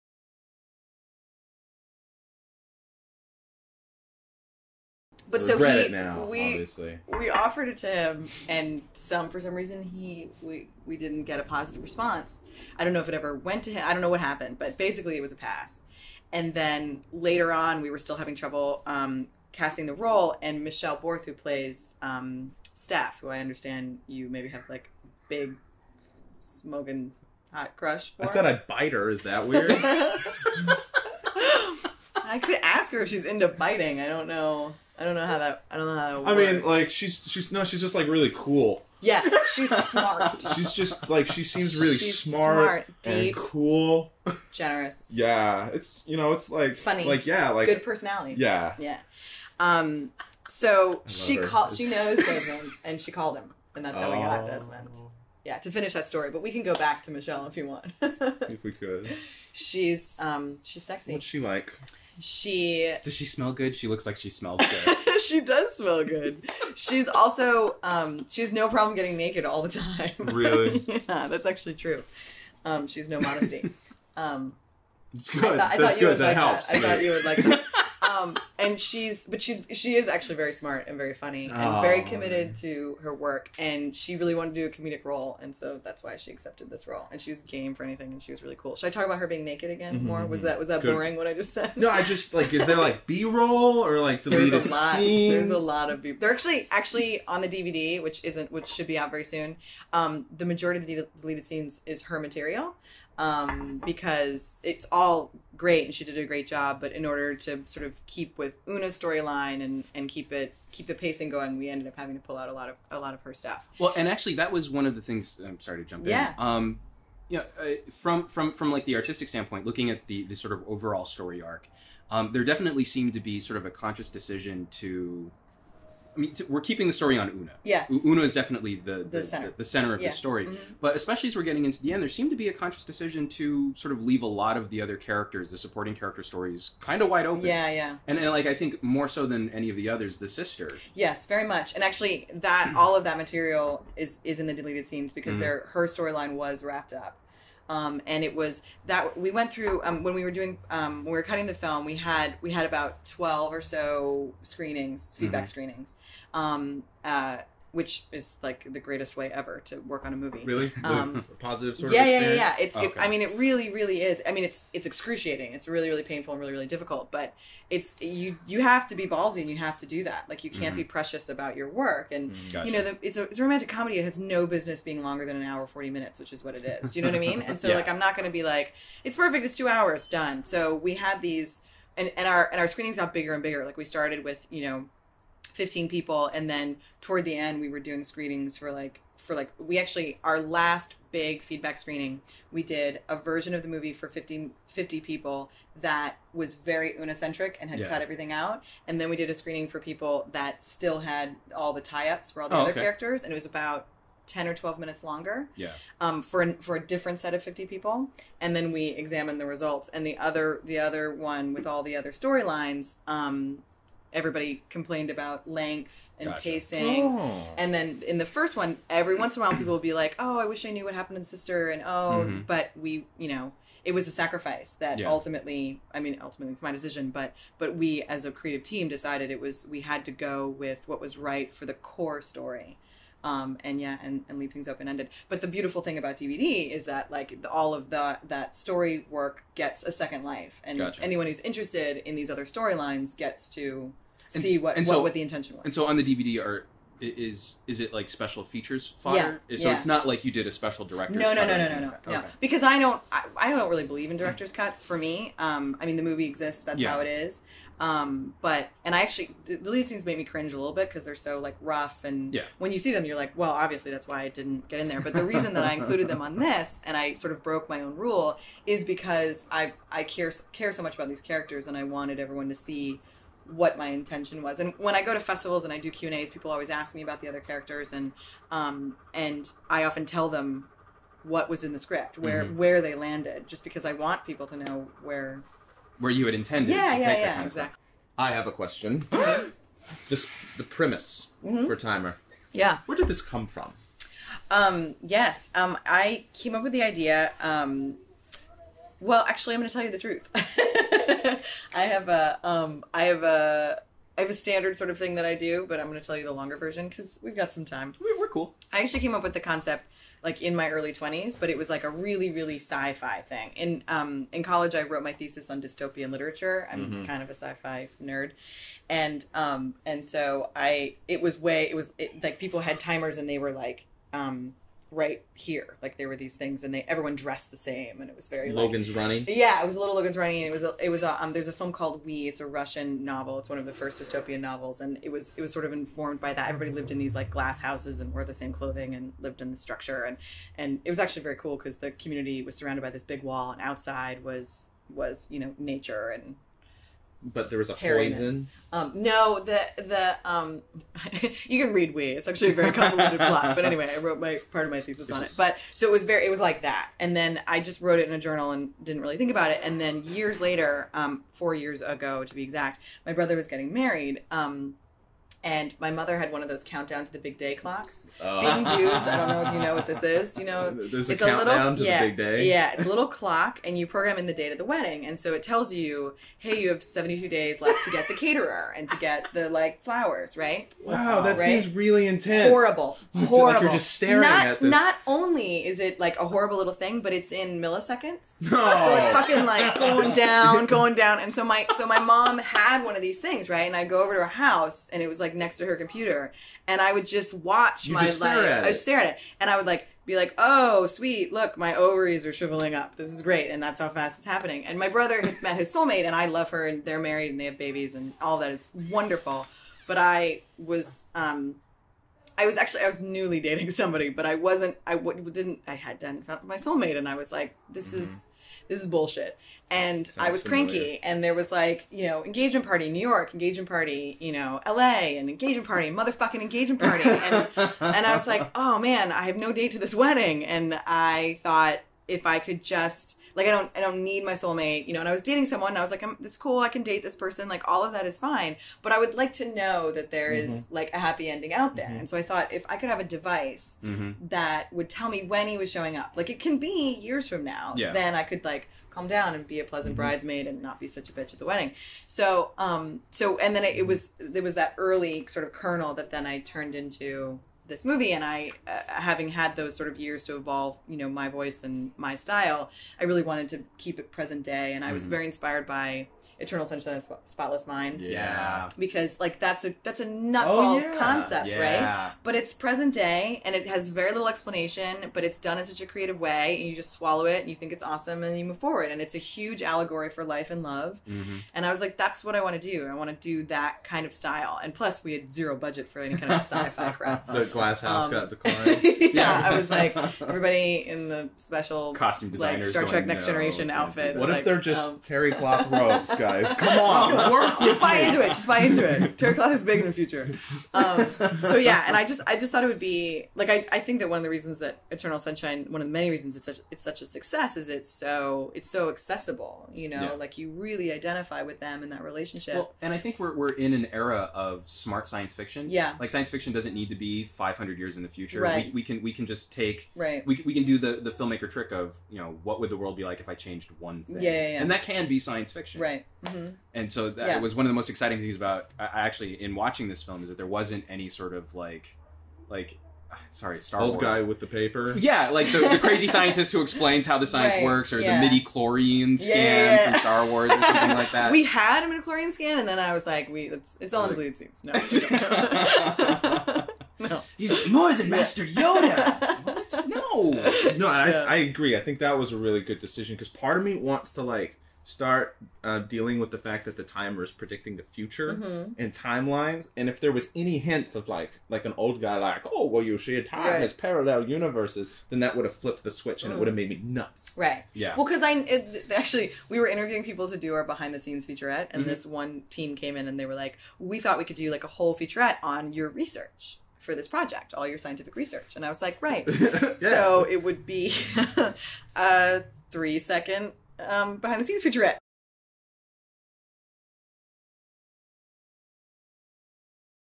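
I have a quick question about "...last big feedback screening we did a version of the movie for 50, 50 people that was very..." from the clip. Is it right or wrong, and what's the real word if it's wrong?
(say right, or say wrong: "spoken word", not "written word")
right.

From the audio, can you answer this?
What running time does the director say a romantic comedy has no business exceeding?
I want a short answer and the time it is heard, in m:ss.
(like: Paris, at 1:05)
1 hour 40 minutes, at 2:55.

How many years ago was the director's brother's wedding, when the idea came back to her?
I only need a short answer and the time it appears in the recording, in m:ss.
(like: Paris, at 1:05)
4, at 6:01.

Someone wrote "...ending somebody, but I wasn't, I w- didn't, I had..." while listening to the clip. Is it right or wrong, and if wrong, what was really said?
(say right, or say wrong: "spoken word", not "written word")
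wrong: "dating", not "ending".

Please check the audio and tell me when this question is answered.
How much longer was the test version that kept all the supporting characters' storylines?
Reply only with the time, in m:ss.
3:24.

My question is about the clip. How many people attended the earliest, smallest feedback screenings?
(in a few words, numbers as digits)
15.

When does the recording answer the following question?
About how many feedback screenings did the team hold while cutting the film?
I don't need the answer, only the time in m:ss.
2:33.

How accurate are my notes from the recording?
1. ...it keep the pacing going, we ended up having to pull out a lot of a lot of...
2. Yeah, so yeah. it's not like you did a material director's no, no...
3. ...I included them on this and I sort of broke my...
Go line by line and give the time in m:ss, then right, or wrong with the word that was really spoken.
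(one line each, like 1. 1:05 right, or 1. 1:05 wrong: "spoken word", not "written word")
1. 1:50 right
2. 4:09 wrong: "special", not "material"
3. 4:25 right.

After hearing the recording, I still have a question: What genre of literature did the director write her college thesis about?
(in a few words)
dystopian literature.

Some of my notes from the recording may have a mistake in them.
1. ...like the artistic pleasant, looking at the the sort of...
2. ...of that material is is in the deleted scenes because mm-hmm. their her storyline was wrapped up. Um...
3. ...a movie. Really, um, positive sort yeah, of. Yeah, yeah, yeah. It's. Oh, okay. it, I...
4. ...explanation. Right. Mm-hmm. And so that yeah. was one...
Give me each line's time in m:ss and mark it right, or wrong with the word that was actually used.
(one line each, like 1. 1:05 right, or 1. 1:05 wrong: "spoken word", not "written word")
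1. 1:58 wrong: "standpoint", not "pleasant"
2. 2:22 right
3. 2:40 right
4. 8:45 wrong: "fiction", not "explanation".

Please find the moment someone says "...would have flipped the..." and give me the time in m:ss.
9:25.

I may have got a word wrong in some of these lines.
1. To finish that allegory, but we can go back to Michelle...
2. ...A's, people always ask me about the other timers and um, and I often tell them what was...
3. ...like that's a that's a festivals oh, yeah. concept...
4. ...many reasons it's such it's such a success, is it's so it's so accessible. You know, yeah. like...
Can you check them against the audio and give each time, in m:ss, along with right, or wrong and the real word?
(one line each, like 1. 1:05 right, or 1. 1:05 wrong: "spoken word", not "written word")
1. 0:55 wrong: "story", not "allegory"
2. 4:36 wrong: "characters", not "timers"
3. 7:49 wrong: "nutballs", not "festivals"
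4. 8:25 right.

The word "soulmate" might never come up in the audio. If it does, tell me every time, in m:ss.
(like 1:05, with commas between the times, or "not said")
6:45, 6:56, 7:14.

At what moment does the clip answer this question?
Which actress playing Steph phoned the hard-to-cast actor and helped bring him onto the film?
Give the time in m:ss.
0:20.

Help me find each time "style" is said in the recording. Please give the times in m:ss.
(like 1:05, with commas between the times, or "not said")
7:42, 8:04.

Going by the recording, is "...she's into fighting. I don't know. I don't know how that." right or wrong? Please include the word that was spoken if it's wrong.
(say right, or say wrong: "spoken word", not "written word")
right.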